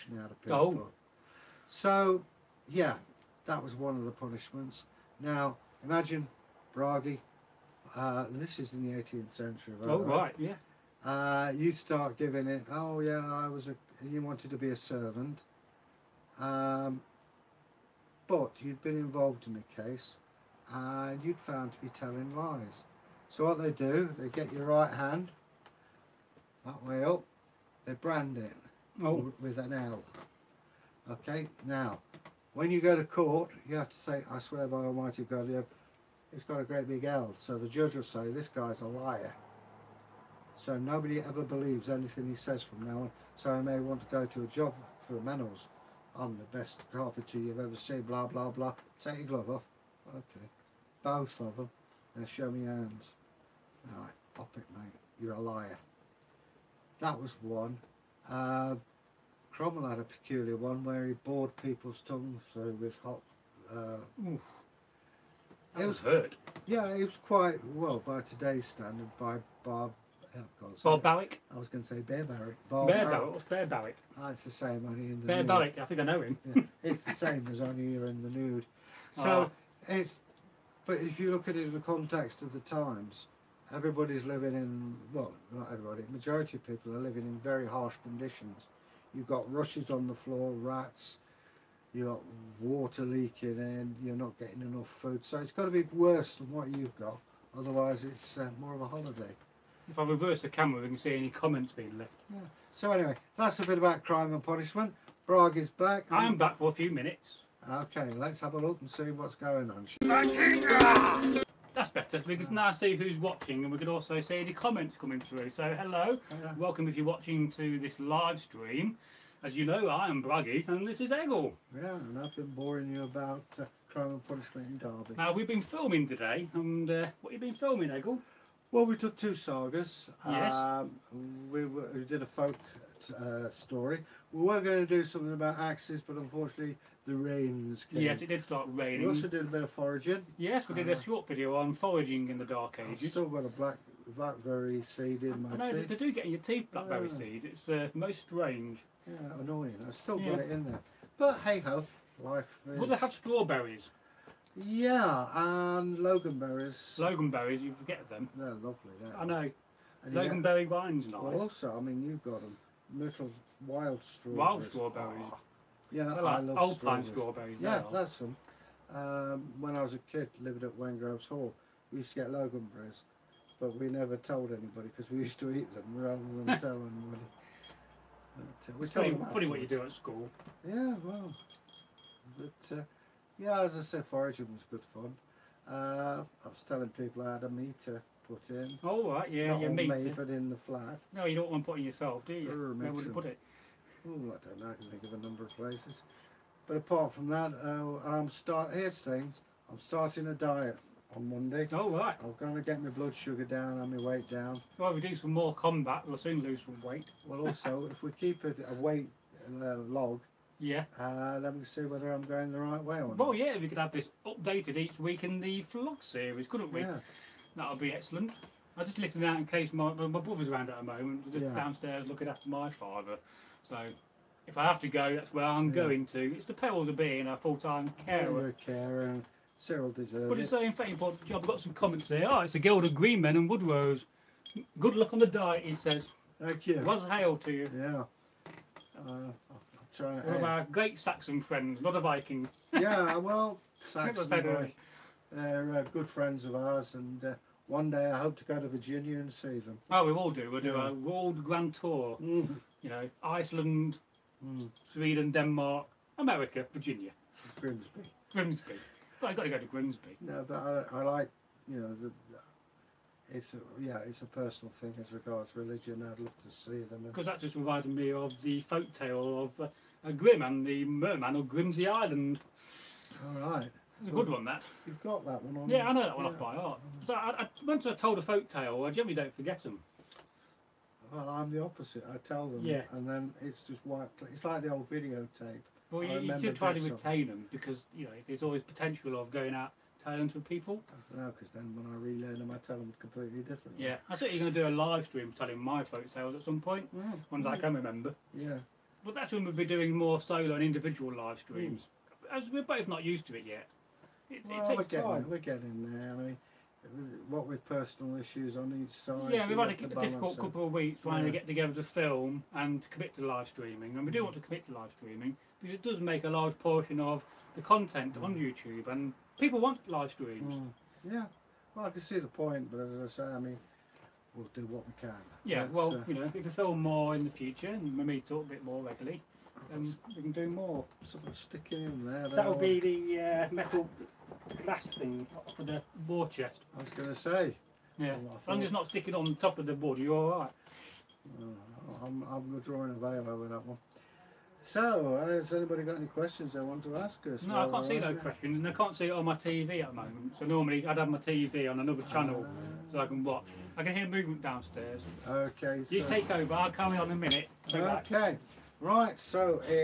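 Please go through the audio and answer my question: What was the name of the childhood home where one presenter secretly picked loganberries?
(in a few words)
Wengroves Hall.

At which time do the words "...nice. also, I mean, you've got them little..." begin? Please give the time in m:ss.
2:41.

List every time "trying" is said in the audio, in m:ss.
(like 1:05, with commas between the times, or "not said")
3:59, 5:11.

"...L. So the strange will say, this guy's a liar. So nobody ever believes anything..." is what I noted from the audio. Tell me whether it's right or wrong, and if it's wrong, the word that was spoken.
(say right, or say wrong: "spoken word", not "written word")
wrong: "judge", not "strange".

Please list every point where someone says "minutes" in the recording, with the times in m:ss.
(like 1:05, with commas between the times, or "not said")
1:46, 5:57.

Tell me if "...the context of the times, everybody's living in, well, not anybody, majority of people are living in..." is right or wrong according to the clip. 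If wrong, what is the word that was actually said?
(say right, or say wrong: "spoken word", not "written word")
wrong: "everybody", not "anybody".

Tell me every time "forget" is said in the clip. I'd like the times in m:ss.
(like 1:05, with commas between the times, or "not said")
2:37, 4:39.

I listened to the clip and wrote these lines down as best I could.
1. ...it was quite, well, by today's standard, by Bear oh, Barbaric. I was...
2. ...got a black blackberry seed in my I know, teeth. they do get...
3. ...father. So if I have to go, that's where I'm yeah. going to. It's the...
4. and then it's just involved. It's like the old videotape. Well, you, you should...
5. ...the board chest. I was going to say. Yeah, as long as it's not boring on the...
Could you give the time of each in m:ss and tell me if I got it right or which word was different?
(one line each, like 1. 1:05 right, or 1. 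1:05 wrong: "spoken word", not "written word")
1. 1:06 wrong: "Bob", not "Bear"
2. 2:23 right
3. 3:42 right
4. 4:42 wrong: "wiped", not "involved"
5. 5:35 wrong: "sticking", not "boring".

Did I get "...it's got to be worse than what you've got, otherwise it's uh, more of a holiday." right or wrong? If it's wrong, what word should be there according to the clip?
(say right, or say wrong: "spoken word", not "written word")
right.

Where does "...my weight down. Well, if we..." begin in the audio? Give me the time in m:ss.
3:23.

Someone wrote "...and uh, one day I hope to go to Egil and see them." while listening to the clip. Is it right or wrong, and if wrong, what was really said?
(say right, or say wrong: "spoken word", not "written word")
wrong: "Virginia", not "Egil".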